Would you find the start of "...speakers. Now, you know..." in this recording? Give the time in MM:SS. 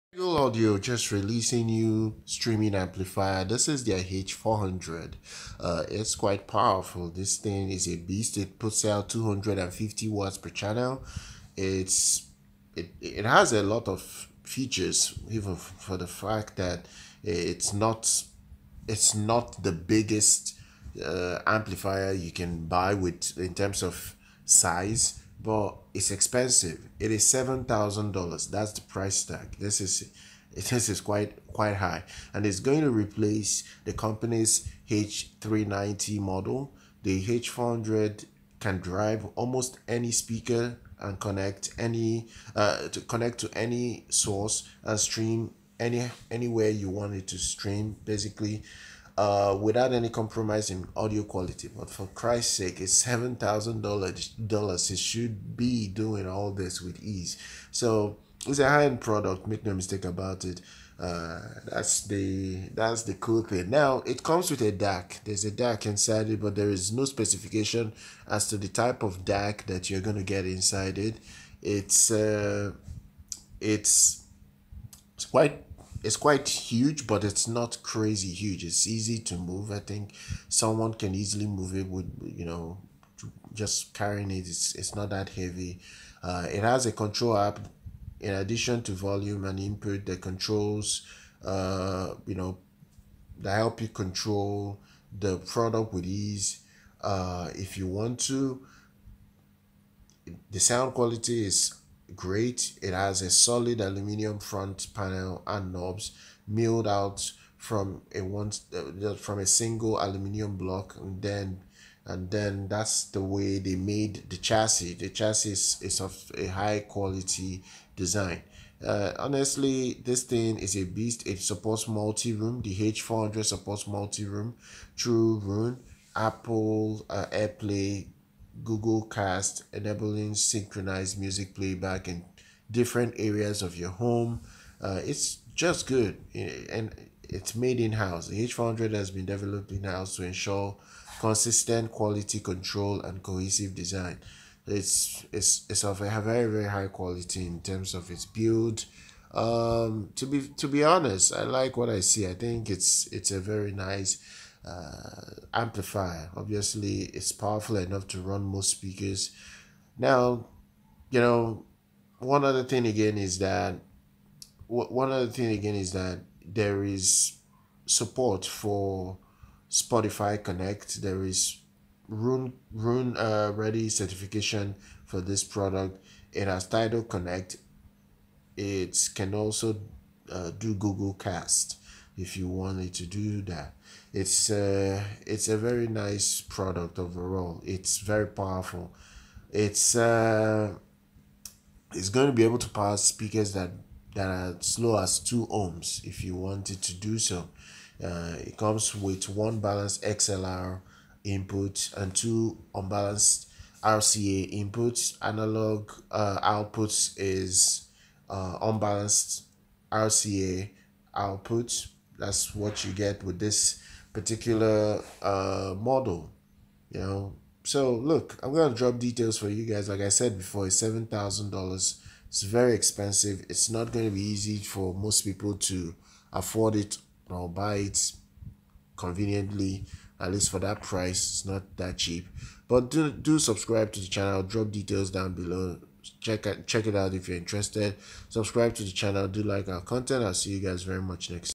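02:38.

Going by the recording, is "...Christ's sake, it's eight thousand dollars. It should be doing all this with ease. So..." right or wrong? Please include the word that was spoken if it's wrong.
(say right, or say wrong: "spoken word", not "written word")
wrong: "seven", not "eight".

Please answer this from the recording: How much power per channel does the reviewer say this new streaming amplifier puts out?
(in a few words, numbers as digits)
250 watts.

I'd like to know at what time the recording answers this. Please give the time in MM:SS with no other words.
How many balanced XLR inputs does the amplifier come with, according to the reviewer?
03:19.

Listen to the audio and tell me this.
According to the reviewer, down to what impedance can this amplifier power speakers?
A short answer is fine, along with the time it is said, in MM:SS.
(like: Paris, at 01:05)
2 ohms, at 03:15.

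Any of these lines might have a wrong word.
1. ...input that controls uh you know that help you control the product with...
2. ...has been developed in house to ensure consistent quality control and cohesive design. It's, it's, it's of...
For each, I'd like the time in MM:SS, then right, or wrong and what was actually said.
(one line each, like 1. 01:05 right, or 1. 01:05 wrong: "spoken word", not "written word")
1. 01:29 right
2. 02:18 right.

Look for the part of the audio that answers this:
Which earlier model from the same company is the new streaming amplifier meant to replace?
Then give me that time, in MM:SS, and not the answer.
00:34.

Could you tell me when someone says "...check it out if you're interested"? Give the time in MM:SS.
03:56.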